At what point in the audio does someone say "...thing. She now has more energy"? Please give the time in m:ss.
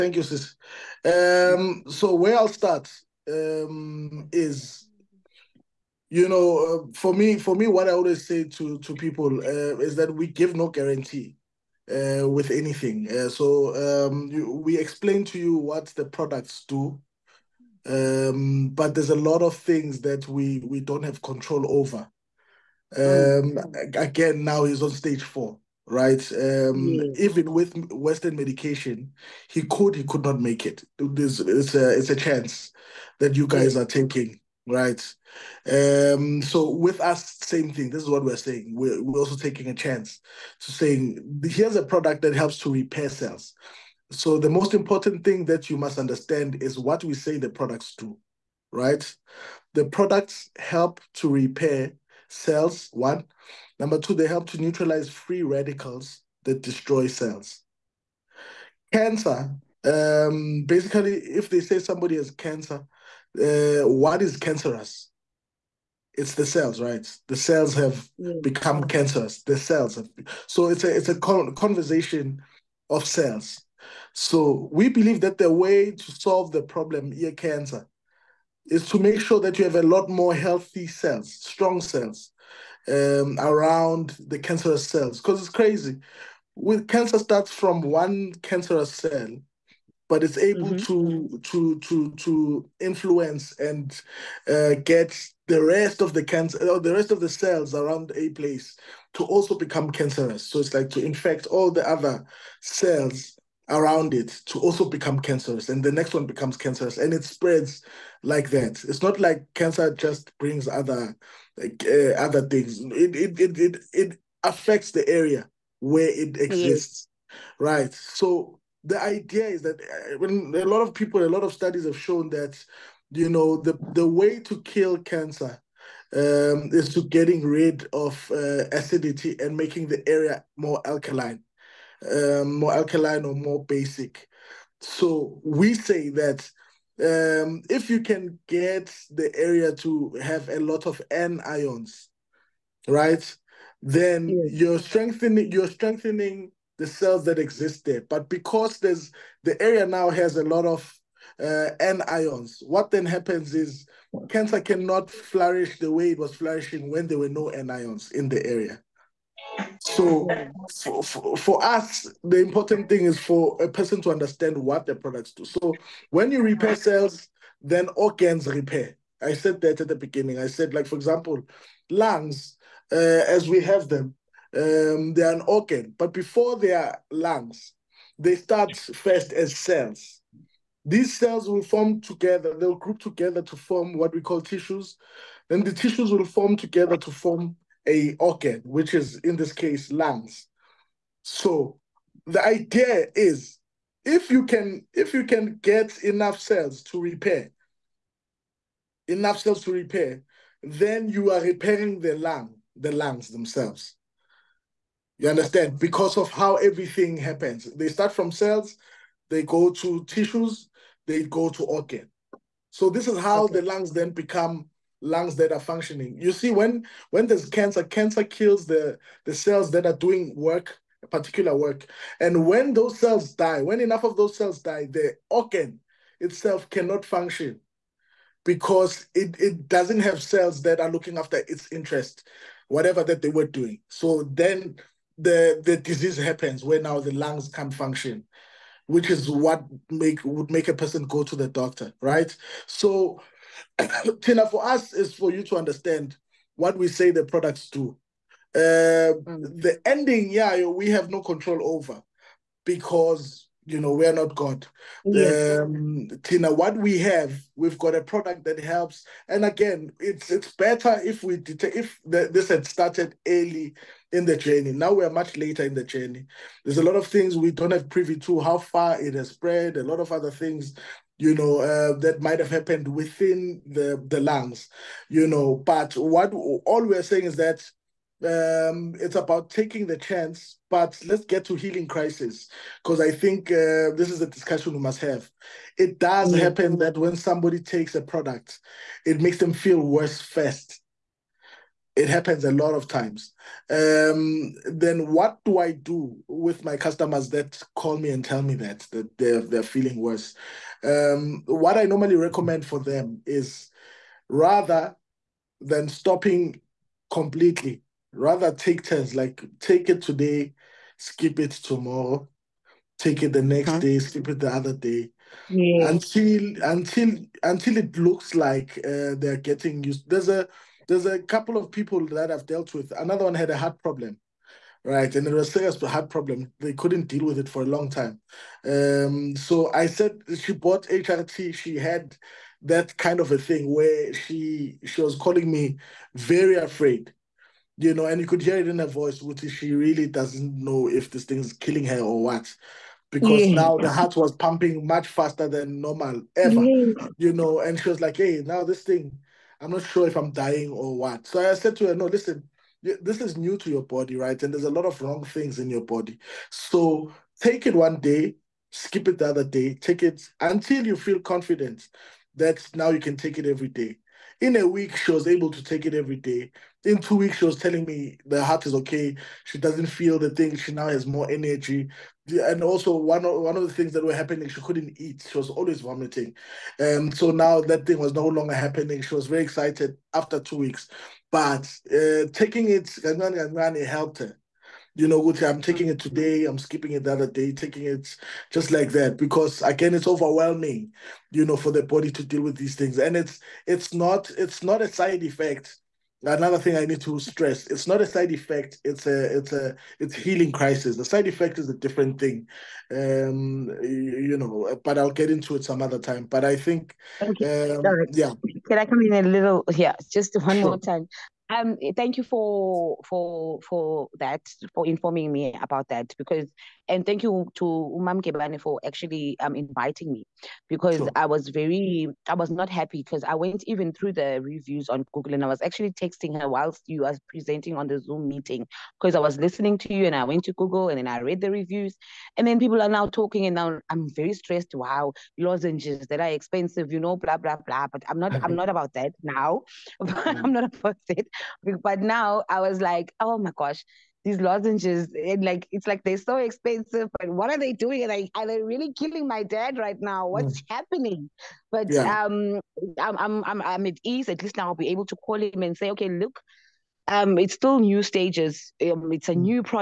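6:10.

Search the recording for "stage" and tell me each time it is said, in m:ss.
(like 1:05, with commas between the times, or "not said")
0:24, 7:38.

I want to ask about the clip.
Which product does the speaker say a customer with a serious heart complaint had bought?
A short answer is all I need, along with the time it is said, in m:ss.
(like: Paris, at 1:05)
HRT, at 5:30.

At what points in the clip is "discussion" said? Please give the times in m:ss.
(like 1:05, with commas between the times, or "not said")
4:44.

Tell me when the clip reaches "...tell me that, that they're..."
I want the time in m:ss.
4:58.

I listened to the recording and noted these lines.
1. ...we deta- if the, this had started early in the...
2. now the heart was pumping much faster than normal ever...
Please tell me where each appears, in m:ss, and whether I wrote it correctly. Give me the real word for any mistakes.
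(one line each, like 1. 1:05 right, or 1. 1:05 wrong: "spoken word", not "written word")
1. 4:21 right
2. 5:43 right.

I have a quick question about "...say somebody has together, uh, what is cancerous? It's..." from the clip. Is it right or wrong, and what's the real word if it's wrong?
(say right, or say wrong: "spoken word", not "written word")
wrong: "cancer", not "together".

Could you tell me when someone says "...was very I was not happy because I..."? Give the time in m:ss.
7:01.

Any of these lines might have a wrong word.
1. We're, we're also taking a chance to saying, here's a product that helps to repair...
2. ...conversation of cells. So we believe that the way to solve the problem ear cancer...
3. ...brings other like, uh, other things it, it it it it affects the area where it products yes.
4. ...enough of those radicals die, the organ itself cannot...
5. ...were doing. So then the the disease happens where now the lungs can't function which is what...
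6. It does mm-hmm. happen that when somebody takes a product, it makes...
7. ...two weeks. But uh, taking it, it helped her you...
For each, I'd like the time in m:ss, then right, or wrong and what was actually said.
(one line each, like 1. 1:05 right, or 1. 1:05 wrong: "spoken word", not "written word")
1. 0:38 right
2. 1:11 right
3. 1:50 wrong: "exists", not "products"
4. 3:43 wrong: "cells", not "radicals"
5. 3:53 right
6. 4:45 right
7. 6:20 right.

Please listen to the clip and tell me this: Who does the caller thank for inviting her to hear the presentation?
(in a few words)
Umam Kebane.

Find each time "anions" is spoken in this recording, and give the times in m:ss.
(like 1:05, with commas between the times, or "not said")
2:21, 2:31, 2:37.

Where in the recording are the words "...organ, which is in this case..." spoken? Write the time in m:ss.
3:08.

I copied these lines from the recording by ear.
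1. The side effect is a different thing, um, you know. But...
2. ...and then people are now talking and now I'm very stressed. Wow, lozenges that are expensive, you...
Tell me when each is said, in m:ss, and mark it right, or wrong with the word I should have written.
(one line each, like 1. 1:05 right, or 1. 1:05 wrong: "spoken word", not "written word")
1. 6:40 right
2. 7:12 right.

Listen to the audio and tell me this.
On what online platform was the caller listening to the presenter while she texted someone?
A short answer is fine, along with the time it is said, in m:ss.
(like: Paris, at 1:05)
Zoom, at 7:07.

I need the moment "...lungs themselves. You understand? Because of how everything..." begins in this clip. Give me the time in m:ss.
3:22.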